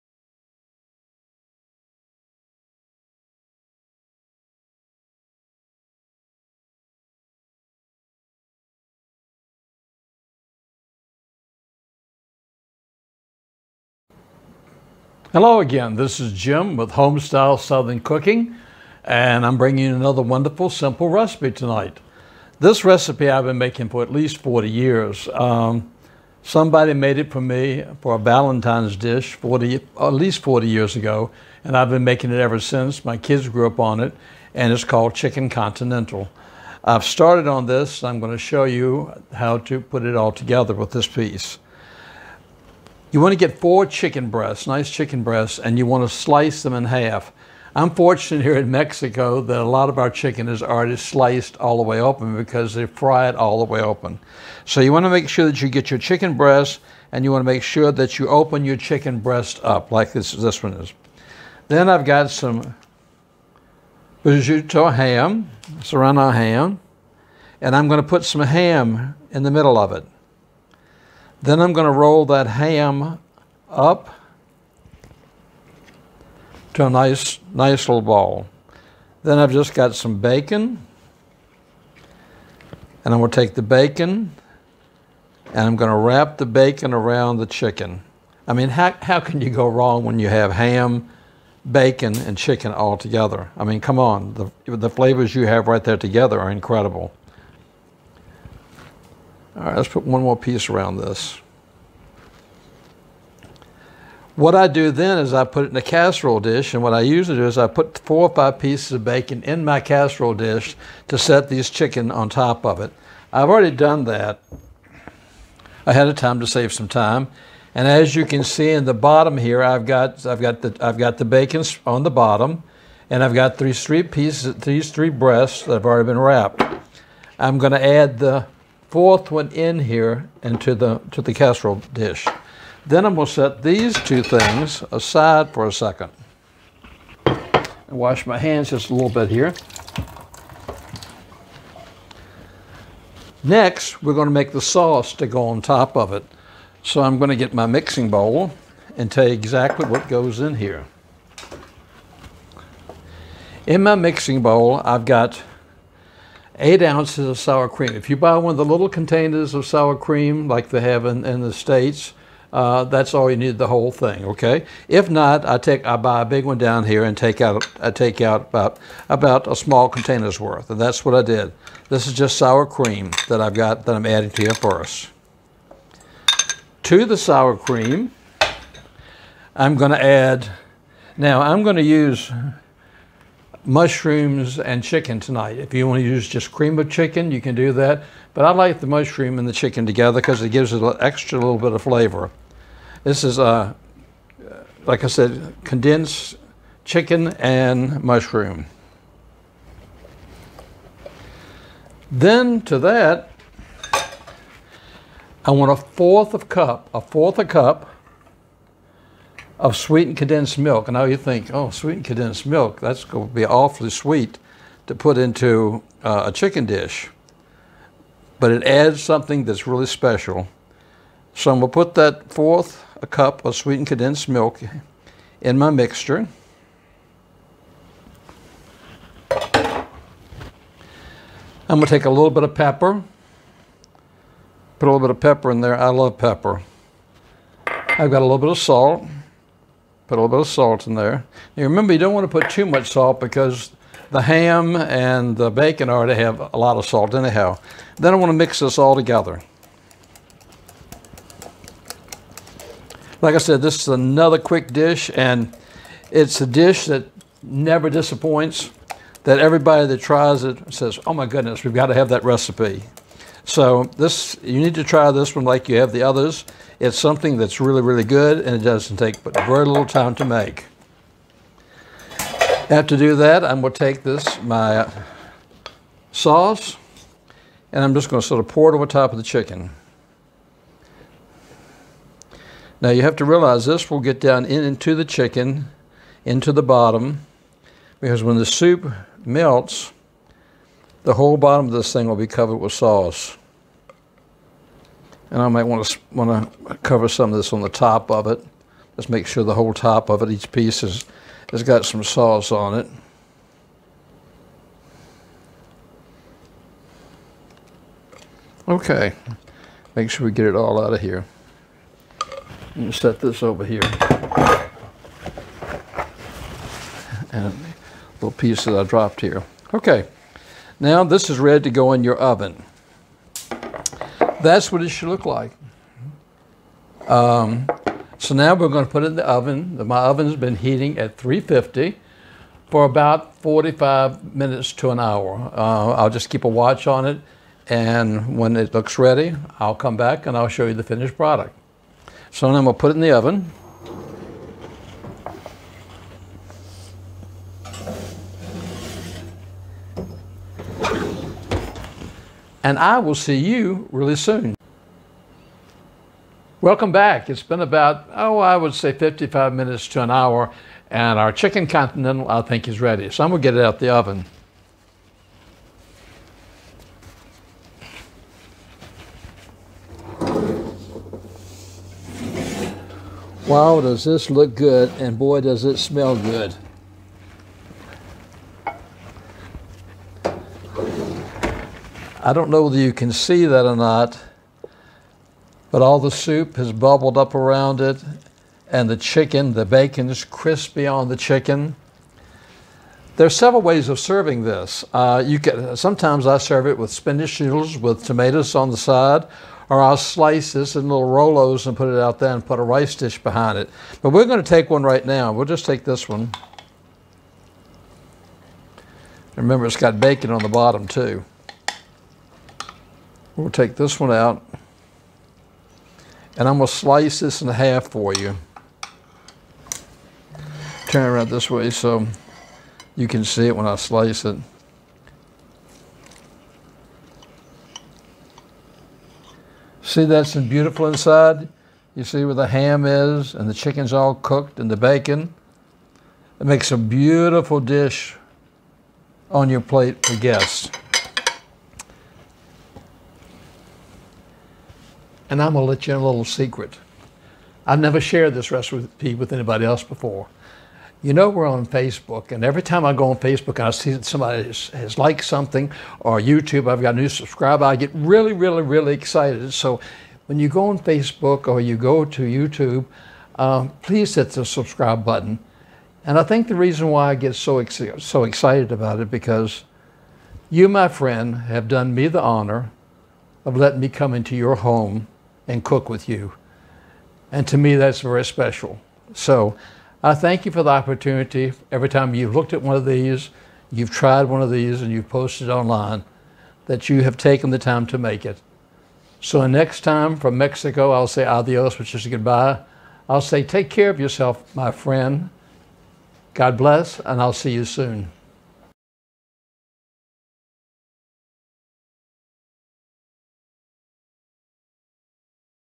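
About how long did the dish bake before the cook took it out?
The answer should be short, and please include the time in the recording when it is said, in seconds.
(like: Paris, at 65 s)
55 minutes to an hour, at 358 s.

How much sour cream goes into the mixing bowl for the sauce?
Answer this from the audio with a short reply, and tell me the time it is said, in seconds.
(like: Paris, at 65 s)
8 ounces, at 156 s.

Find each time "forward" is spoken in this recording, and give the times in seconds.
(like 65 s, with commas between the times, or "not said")
not said.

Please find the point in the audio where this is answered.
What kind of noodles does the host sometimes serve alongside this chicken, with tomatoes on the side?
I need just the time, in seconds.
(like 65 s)
396 s.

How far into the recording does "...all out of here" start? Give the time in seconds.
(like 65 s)
310 s.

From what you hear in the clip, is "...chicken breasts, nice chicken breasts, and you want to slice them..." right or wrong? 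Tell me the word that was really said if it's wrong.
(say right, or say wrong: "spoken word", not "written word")
right.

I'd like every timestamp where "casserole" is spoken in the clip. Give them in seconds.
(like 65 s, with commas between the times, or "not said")
105 s, 109 s, 131 s.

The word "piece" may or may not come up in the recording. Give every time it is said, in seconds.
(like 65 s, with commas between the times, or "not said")
41 s, 100 s, 108 s, 124 s, 300 s, 318 s.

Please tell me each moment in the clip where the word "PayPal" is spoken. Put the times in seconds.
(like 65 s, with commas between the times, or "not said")
not said.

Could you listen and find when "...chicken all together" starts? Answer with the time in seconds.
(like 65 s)
92 s.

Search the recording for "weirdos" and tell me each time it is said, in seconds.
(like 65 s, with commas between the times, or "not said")
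not said.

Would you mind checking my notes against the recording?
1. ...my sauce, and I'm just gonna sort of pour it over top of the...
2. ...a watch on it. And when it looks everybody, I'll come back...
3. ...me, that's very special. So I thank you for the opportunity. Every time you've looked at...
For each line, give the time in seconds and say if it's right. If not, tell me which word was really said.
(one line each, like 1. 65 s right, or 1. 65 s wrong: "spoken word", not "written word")
1. 274 s right
2. 336 s wrong: "ready", not "everybody"
3. 477 s right.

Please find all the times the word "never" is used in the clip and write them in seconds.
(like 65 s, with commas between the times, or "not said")
257 s, 447 s.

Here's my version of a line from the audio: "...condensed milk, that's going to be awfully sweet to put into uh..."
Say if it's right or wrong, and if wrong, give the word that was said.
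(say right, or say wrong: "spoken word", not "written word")
right.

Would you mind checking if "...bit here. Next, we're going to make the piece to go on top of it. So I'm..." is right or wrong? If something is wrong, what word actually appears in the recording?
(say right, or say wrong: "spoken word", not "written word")
wrong: "sauce", not "piece".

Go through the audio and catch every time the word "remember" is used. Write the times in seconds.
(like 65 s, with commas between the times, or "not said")
241 s, 409 s.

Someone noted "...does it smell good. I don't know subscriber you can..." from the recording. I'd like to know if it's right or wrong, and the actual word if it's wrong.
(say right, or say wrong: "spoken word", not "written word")
wrong: "whether", not "subscriber".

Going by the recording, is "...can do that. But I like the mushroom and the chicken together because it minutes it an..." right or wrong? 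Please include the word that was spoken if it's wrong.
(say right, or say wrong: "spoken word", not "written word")
wrong: "gives", not "minutes".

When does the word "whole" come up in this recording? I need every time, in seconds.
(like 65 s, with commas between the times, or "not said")
163 s, 291 s, 299 s.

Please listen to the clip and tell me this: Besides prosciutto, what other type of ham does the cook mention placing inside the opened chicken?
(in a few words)
serrano ham.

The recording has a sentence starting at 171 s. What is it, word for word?
This is just sour cream that I've got that I'm adding to here for us.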